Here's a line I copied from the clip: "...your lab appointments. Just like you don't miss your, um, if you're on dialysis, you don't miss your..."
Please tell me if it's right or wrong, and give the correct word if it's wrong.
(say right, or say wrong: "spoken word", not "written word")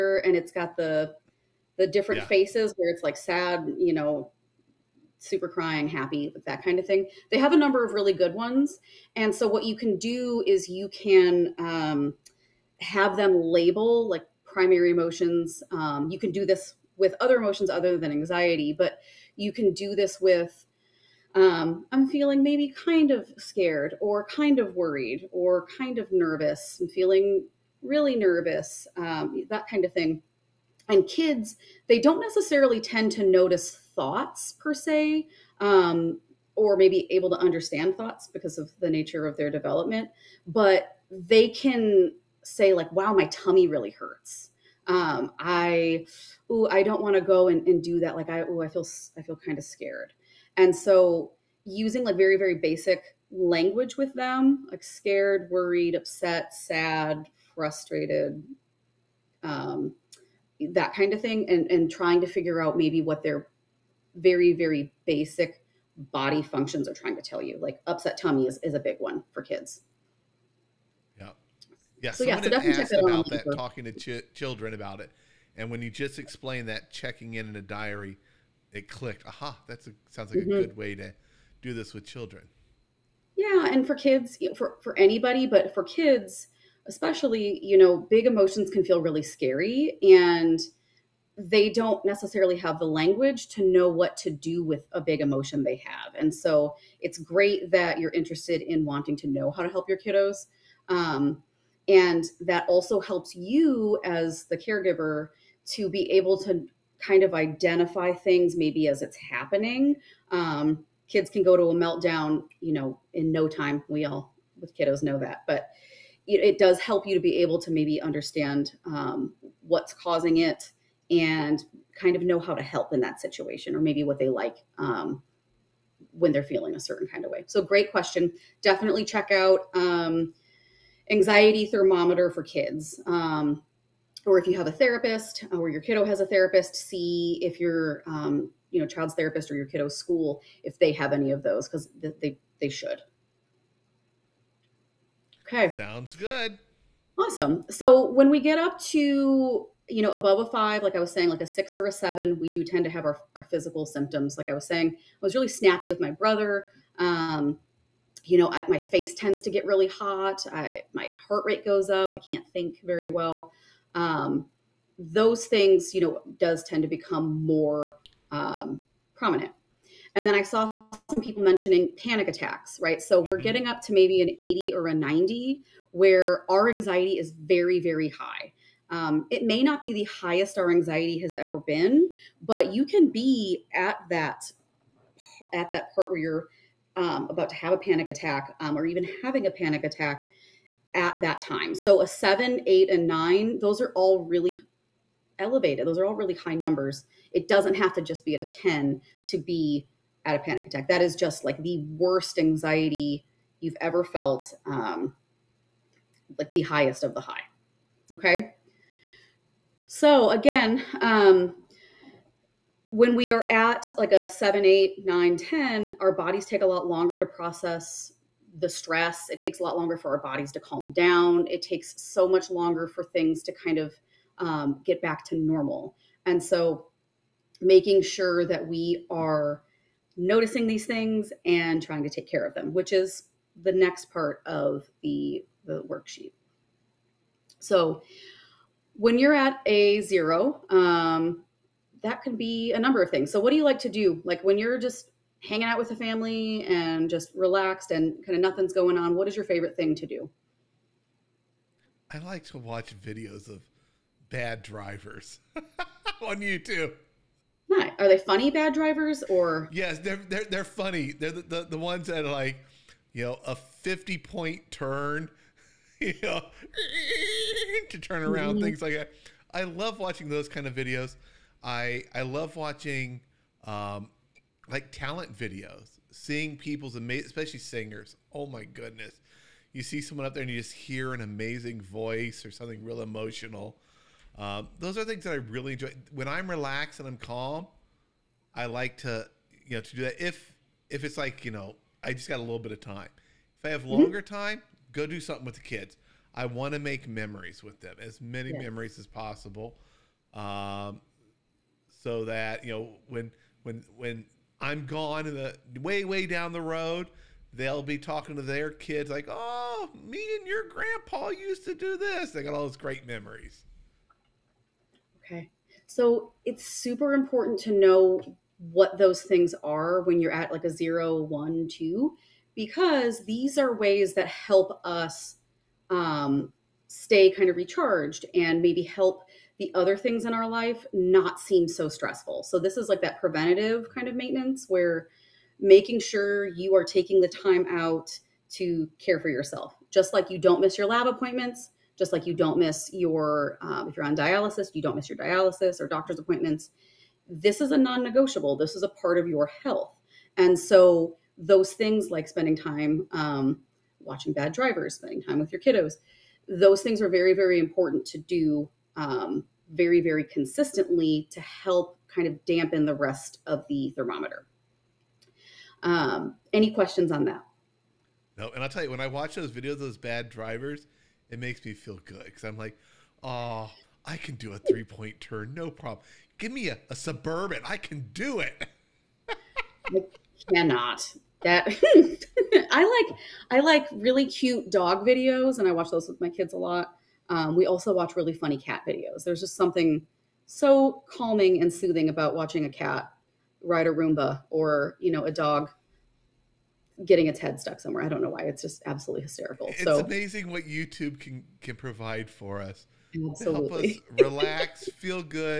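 right.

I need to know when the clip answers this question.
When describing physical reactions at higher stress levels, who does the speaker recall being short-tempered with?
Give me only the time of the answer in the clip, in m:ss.
2:35.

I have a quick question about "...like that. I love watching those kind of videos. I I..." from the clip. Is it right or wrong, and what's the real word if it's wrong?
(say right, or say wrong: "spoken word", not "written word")
right.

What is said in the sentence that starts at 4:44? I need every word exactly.
Um, those are things that I really enjoy.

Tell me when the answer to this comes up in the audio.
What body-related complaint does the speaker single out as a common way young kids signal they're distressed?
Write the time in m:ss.
1:07.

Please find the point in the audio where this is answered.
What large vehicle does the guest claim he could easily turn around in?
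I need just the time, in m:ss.
6:16.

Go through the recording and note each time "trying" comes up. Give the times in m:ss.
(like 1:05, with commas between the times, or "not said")
1:01, 1:06, 3:51.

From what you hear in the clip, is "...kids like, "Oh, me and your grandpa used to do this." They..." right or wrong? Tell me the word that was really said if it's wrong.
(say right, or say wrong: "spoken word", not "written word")
right.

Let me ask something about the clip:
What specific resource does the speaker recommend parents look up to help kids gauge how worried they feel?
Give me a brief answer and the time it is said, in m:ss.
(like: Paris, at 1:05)
Anxiety Thermometer for Kids, at 2:11.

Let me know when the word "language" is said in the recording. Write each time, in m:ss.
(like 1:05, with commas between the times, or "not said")
0:53, 1:32.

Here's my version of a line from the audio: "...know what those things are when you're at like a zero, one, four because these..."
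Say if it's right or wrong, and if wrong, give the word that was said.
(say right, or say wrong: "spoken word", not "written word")
wrong: "two", not "four".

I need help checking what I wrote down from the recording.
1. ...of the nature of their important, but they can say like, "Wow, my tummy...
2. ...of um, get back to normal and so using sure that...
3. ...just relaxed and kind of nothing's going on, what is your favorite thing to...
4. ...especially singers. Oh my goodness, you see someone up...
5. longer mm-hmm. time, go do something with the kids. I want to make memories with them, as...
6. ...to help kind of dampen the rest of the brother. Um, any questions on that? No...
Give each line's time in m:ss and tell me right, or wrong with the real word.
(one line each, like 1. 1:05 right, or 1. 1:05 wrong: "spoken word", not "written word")
1. 0:38 wrong: "development", not "important"
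2. 3:43 wrong: "making", not "using"
3. 4:07 right
4. 4:37 right
5. 4:53 right
6. 6:01 wrong: "thermometer", not "brother".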